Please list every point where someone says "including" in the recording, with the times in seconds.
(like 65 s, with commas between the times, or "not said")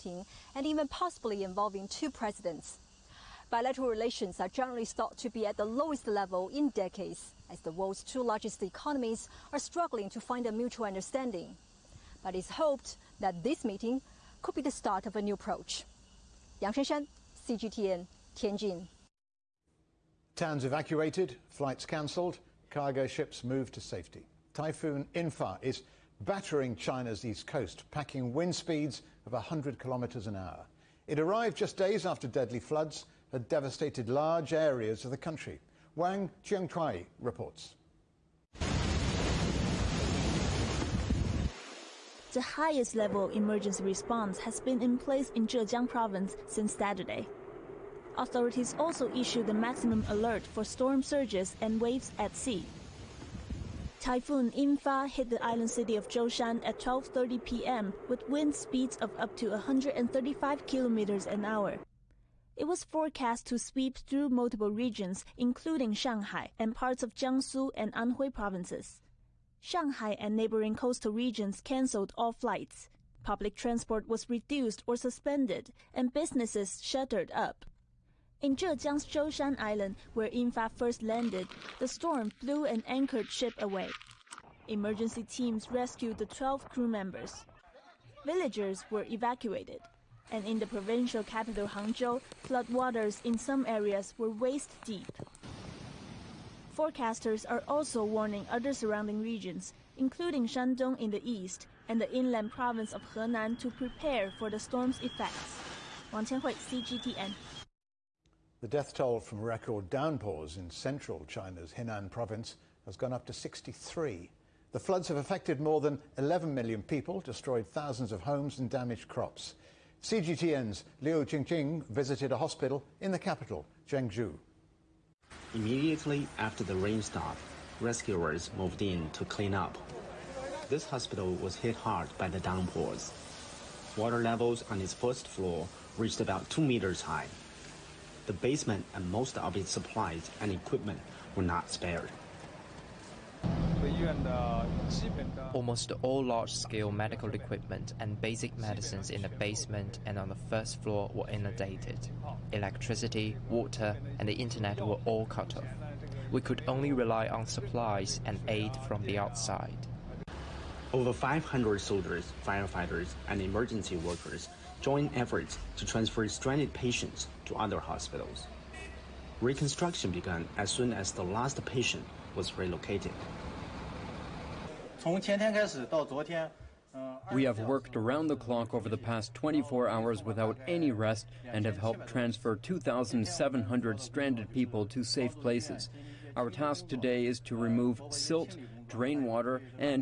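65 s, 99 s.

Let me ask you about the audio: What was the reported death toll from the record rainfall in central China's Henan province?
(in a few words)
63.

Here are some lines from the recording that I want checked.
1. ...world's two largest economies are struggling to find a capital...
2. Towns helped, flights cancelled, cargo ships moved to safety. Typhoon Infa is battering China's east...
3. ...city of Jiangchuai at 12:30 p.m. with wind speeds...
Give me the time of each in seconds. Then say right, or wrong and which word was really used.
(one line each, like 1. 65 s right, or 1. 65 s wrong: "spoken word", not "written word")
1. 7 s wrong: "mutual", not "capital"
2. 20 s wrong: "evacuated", not "helped"
3. 55 s wrong: "Zhoushan", not "Jiangchuai".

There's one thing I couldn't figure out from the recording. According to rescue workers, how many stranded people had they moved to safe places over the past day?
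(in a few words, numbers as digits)
2,700.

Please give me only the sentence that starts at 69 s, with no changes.
Shanghai and neighboring coastal regions canceled all flights.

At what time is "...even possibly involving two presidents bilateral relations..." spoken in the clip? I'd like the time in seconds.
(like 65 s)
0 s.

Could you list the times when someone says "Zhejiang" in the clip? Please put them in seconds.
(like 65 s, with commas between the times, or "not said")
45 s, 78 s.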